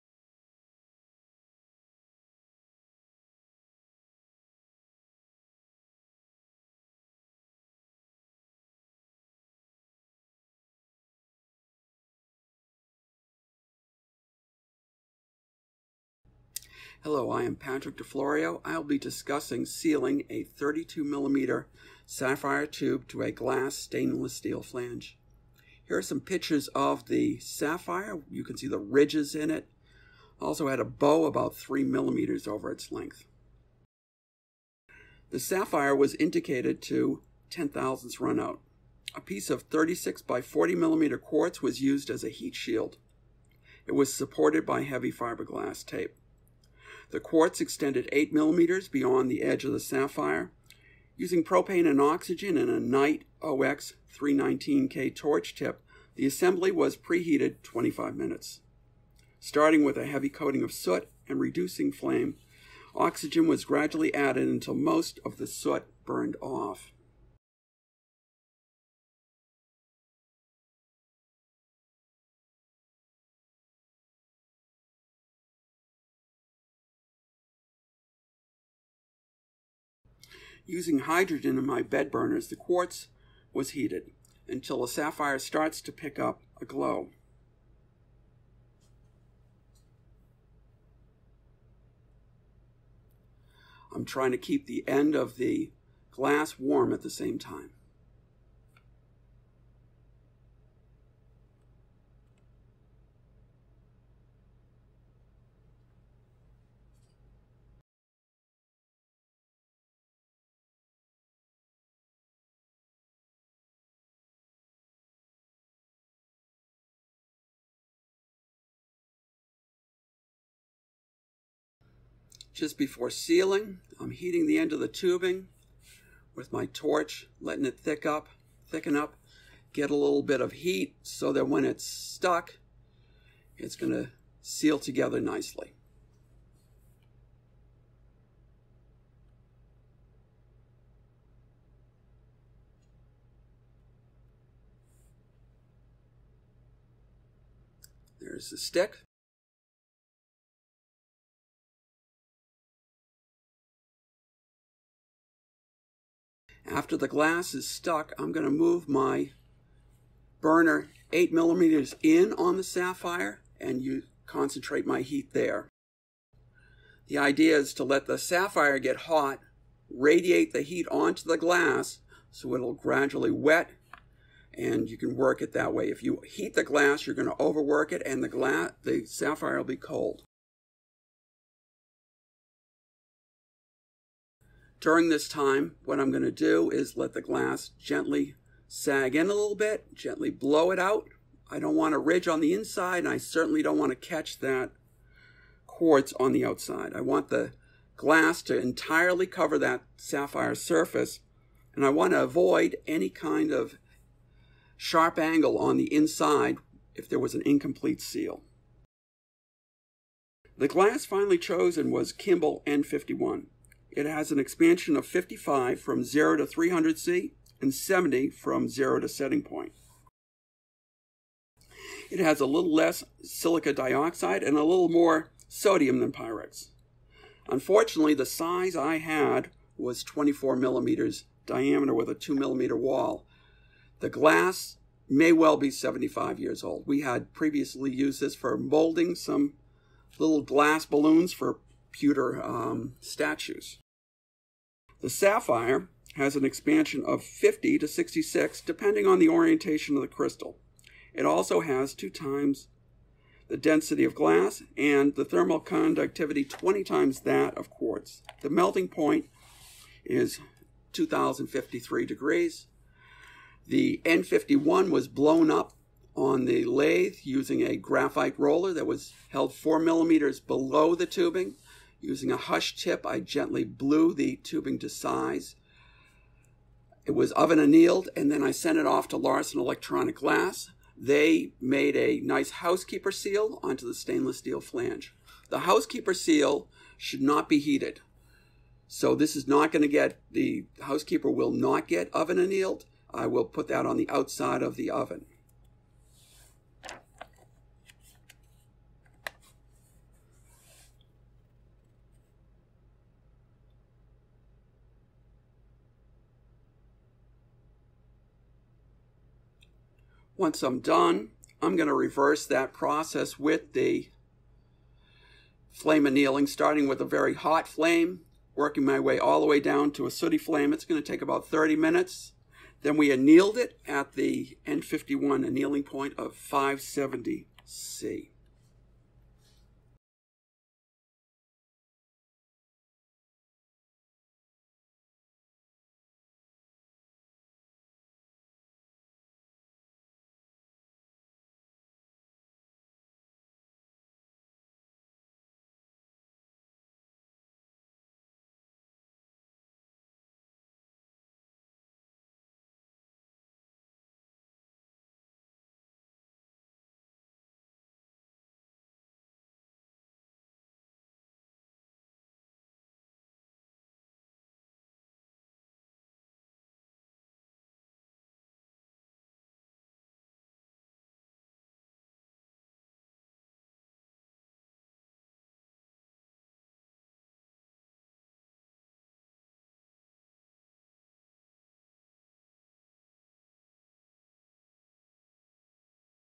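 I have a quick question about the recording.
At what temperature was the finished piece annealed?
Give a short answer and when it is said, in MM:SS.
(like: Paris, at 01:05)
570 C, at 05:26.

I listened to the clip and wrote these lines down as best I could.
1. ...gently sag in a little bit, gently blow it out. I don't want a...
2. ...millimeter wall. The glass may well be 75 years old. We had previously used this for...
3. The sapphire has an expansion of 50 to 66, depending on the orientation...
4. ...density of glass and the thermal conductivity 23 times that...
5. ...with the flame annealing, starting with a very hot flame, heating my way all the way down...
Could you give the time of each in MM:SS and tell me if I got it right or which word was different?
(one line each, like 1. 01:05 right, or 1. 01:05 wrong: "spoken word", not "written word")
1. 03:07 right
2. 03:52 right
3. 04:05 right
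4. 04:13 wrong: "20", not "23"
5. 05:13 wrong: "working", not "heating".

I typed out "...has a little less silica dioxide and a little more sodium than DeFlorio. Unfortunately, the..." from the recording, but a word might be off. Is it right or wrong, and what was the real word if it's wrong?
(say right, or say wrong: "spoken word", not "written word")
wrong: "Pyrex", not "DeFlorio".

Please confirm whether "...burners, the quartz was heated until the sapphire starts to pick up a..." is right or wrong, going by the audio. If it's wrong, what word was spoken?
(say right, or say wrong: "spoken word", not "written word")
right.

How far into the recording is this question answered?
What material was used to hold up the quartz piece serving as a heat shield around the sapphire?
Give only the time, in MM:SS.
00:44.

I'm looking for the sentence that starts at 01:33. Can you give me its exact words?
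I'm trying to keep the end of the glass warm at the same time.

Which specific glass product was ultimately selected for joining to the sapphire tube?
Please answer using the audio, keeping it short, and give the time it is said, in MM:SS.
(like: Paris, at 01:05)
Kimble N51, at 03:32.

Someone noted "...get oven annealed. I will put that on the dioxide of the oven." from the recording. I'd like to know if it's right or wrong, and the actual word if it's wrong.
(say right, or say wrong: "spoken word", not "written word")
wrong: "outside", not "dioxide".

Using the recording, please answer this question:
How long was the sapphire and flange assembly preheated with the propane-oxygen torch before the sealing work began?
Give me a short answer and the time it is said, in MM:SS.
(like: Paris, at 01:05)
25 minutes, at 00:57.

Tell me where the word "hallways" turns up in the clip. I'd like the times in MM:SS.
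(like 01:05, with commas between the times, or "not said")
not said.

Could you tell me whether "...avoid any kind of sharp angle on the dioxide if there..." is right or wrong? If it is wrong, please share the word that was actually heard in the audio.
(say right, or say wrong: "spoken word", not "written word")
wrong: "inside", not "dioxide".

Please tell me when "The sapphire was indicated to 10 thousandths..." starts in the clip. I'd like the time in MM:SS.
00:35.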